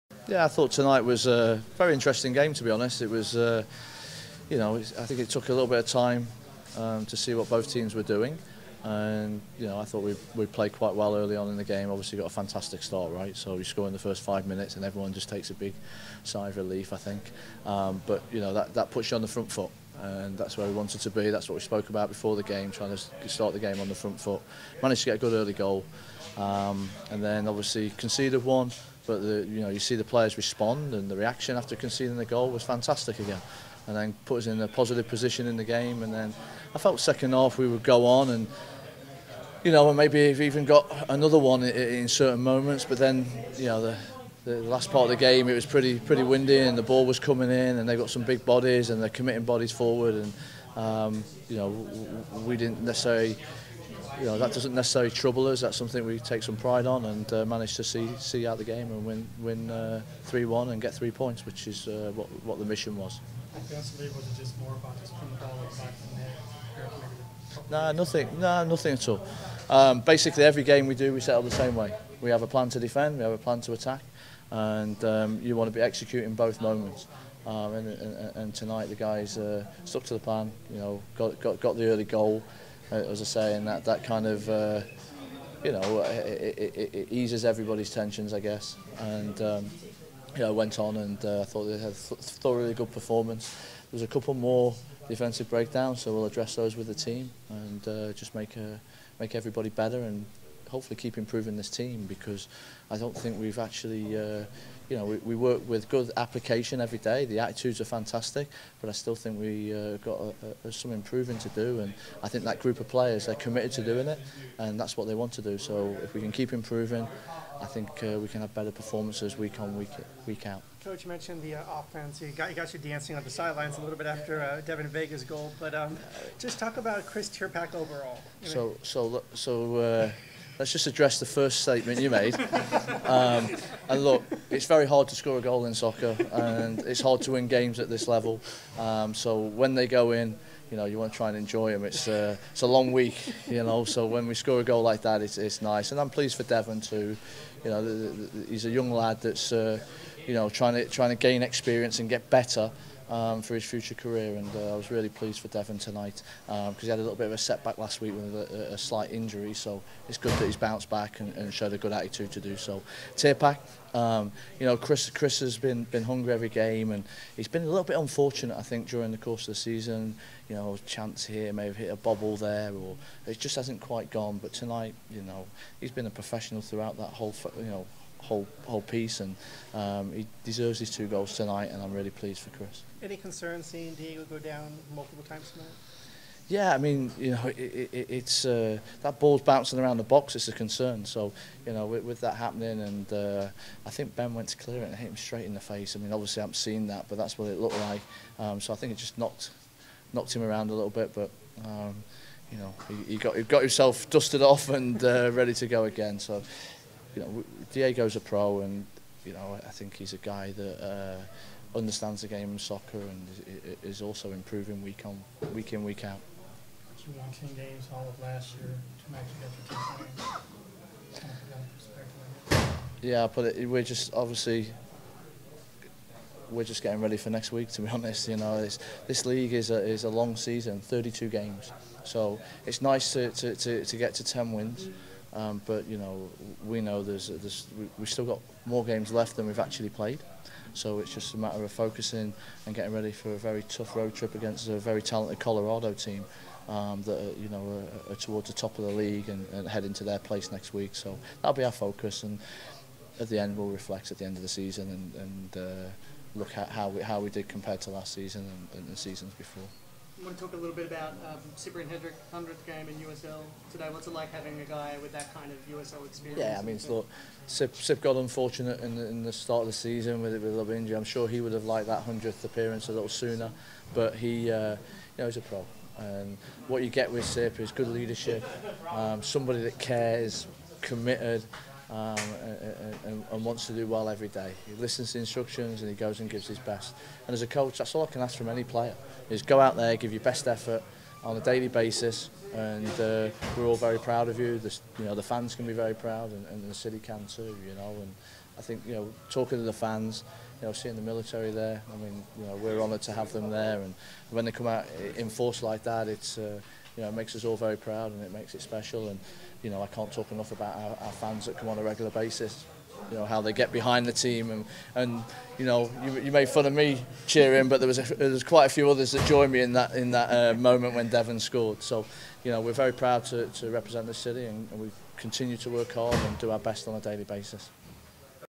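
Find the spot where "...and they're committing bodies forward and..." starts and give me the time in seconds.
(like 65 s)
48 s.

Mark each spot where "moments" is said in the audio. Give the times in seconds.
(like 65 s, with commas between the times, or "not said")
42 s, 76 s, 320 s.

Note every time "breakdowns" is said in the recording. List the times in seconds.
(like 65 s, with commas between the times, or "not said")
95 s.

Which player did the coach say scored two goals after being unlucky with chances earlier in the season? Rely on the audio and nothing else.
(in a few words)
Chris Tirpak.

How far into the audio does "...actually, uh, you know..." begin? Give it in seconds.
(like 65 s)
103 s.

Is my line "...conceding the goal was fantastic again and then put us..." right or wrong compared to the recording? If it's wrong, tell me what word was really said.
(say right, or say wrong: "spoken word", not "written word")
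right.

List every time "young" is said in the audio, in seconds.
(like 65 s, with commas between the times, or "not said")
148 s.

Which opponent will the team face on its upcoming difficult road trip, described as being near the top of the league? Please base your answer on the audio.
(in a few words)
Colorado.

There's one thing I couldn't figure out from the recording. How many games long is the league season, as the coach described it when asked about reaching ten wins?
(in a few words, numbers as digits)
32.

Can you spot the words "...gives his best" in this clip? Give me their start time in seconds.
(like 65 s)
286 s.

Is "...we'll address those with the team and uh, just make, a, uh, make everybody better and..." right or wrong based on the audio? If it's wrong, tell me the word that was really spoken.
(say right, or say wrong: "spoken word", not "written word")
right.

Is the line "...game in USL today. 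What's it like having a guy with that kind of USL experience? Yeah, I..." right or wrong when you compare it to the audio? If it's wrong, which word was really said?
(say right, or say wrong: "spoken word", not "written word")
right.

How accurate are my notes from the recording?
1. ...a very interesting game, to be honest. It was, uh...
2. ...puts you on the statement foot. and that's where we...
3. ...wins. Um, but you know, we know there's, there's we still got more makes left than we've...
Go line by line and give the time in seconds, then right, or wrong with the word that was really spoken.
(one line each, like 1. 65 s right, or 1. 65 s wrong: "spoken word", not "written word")
1. 1 s right
2. 18 s wrong: "front", not "statement"
3. 234 s wrong: "games", not "makes".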